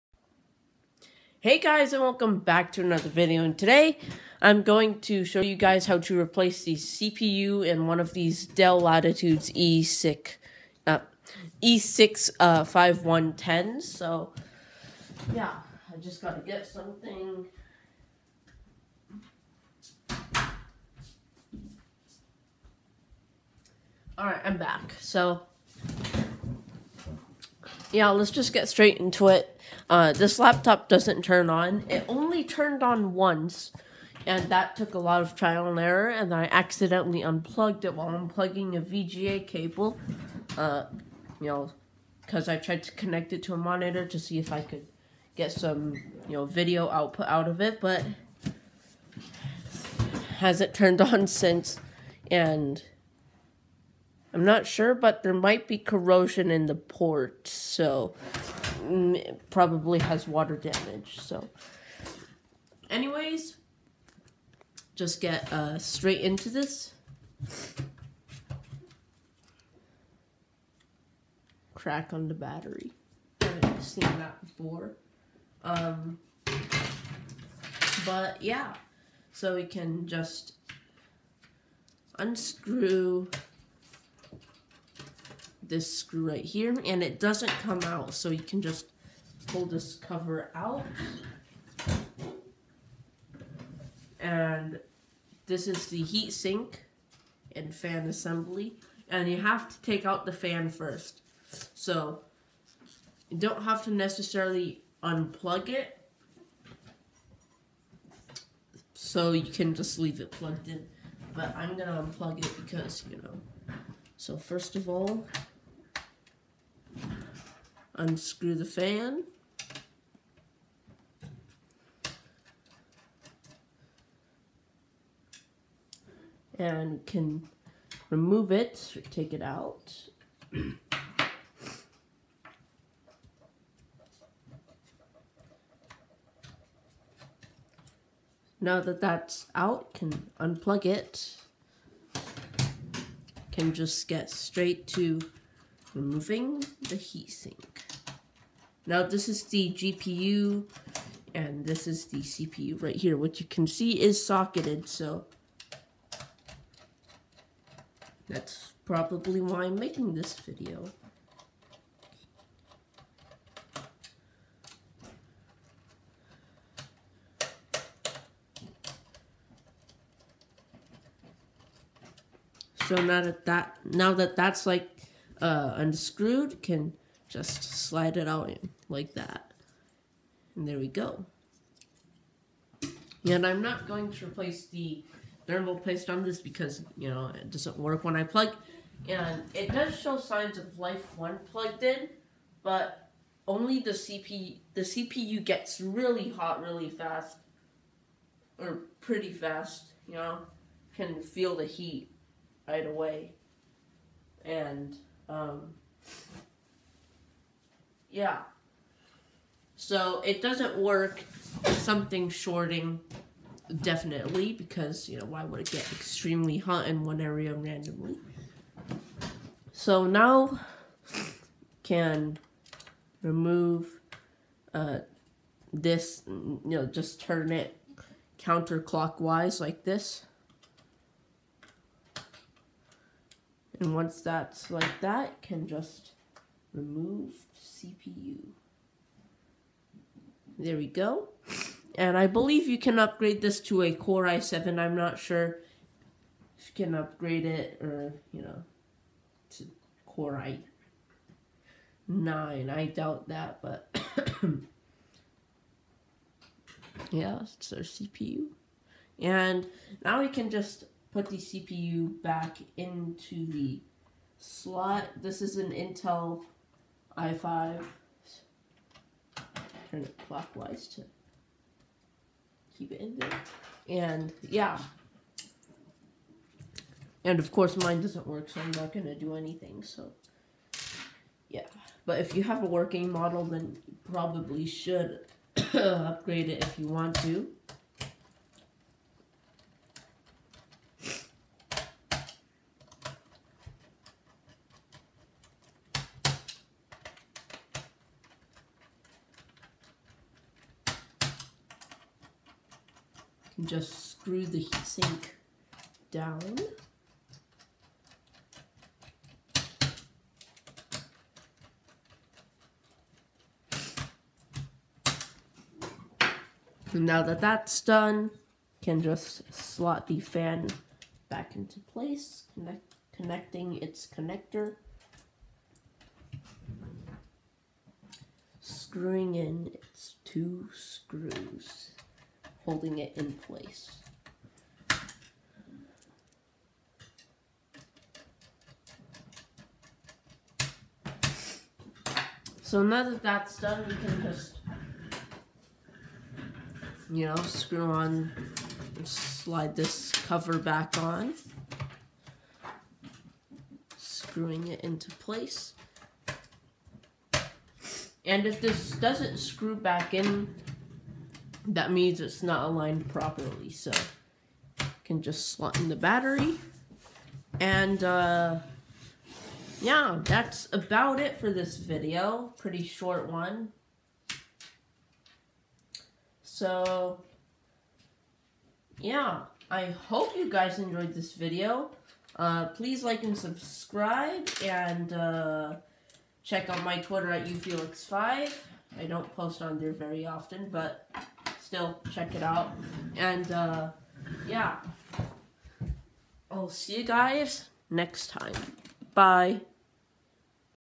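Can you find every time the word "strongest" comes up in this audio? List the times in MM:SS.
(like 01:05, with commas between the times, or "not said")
not said.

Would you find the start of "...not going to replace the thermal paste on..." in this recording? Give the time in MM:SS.
03:03.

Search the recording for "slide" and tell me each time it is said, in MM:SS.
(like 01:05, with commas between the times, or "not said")
02:57, 05:49.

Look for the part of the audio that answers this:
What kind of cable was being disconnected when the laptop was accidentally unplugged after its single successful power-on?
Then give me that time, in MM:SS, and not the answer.
00:38.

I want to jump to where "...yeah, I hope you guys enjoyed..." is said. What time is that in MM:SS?
06:18.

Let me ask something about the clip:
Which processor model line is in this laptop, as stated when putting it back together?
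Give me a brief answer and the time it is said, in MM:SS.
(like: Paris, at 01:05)
Intel i5, at 04:25.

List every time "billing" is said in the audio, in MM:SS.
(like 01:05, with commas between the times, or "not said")
not said.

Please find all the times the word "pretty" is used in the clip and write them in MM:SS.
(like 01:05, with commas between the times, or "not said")
03:18, 06:12.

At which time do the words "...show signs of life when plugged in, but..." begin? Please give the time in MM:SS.
03:09.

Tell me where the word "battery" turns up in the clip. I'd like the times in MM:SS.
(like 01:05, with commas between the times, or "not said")
01:12, 06:05.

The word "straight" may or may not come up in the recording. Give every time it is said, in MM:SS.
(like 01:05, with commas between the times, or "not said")
00:28, 01:05, 02:24.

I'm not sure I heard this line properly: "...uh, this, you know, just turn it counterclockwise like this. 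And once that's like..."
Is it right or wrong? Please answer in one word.
right.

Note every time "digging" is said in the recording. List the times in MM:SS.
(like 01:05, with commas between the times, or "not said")
not said.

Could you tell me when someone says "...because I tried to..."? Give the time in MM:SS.
00:42.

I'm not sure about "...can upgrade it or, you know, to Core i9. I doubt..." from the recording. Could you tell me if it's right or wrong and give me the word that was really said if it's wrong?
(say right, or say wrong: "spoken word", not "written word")
right.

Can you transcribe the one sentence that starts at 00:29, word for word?
Uh, this laptop doesn't turn on.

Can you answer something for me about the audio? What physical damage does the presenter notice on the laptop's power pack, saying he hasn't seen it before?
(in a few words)
Crack.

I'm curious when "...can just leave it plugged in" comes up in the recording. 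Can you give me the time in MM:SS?
01:49.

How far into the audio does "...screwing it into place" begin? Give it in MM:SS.
05:53.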